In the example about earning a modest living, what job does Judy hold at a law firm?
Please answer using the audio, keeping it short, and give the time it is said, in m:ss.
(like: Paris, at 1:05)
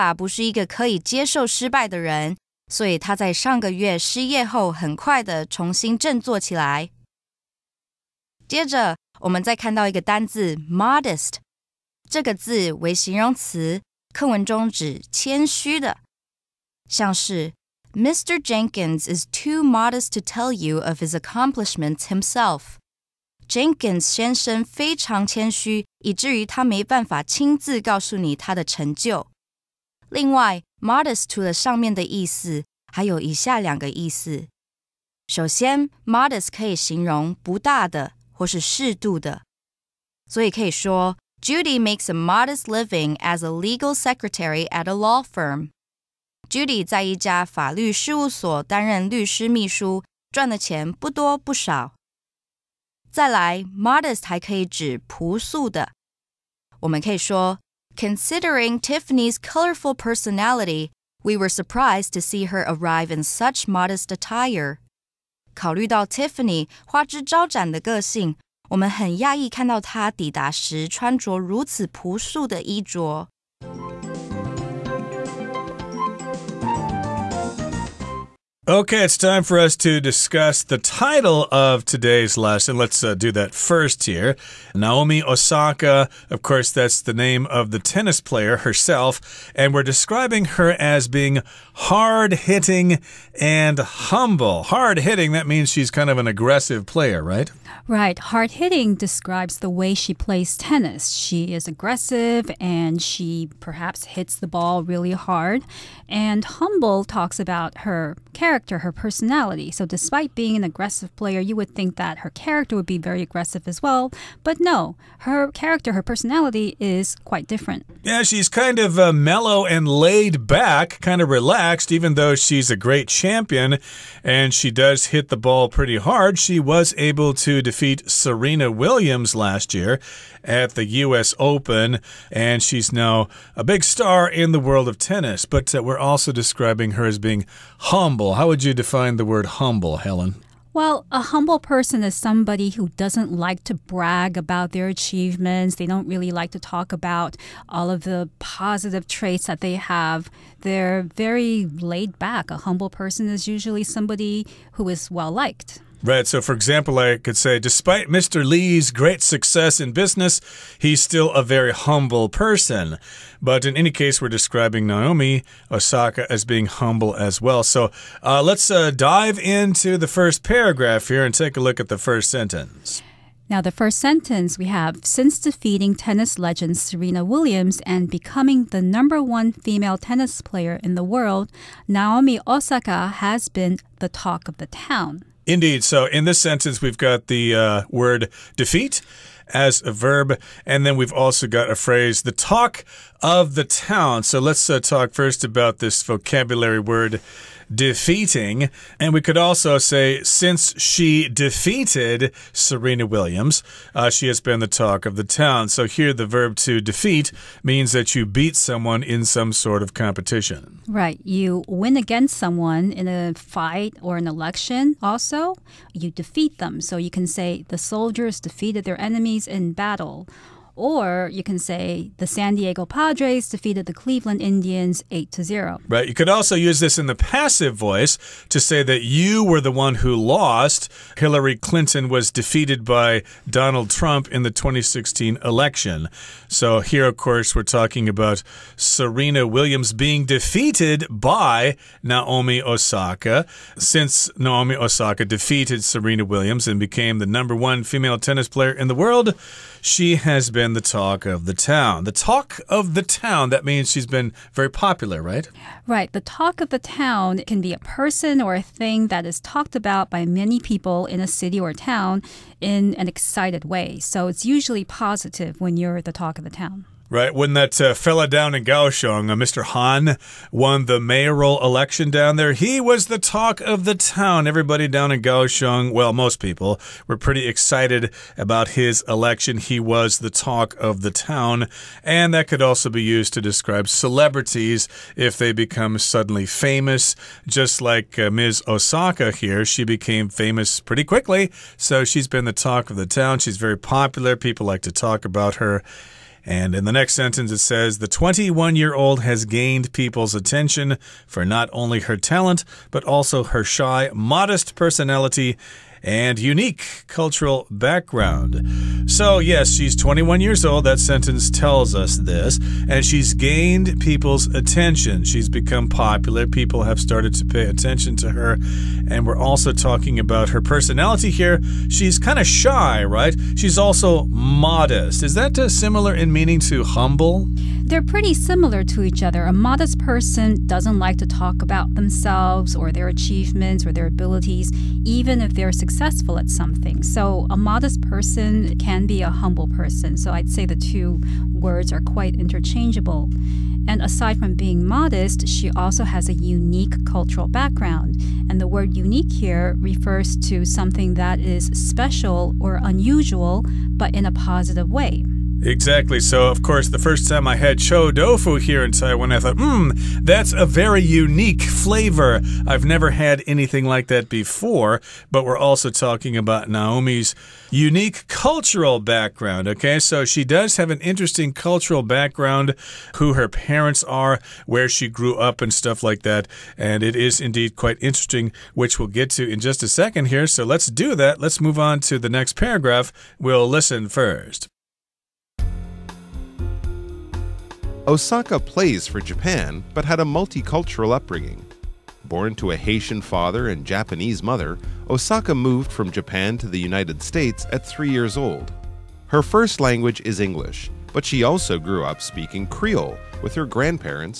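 legal secretary, at 0:43.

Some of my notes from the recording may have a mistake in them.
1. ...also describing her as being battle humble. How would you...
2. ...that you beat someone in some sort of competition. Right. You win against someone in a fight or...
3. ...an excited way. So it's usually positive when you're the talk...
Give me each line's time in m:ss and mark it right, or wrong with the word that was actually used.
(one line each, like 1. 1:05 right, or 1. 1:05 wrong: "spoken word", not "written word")
1. 2:15 wrong: "humble", not "battle"
2. 3:27 right
3. 4:22 right.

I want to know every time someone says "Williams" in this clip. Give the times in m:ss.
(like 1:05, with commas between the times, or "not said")
2:08, 2:57, 3:23, 3:59, 4:06.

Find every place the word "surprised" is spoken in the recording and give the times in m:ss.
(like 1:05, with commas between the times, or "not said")
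1:01.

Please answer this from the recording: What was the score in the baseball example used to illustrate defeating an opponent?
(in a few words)
8 to 0.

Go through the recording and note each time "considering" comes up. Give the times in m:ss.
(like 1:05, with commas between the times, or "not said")
0:57.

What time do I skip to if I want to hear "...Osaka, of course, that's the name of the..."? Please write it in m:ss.
1:25.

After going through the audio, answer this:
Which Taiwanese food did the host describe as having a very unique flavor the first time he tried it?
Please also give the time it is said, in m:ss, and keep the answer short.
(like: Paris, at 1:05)
cho tofu, at 5:57.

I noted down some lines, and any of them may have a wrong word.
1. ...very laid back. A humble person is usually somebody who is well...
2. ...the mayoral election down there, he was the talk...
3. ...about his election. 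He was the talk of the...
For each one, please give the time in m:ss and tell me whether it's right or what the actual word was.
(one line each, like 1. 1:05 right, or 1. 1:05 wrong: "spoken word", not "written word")
1. 2:31 right
2. 4:30 right
3. 4:38 right.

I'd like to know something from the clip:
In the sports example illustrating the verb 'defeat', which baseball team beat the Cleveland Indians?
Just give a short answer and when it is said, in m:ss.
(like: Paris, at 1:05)
San Diego Padres, at 3:42.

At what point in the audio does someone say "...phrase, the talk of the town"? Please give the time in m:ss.
3:11.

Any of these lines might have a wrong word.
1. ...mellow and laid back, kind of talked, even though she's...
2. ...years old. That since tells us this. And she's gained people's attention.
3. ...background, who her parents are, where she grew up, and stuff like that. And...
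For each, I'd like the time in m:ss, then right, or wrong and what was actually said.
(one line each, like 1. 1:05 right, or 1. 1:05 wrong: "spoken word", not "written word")
1. 1:59 wrong: "relaxed", not "talked"
2. 5:10 wrong: "sentence", not "since"
3. 6:12 right.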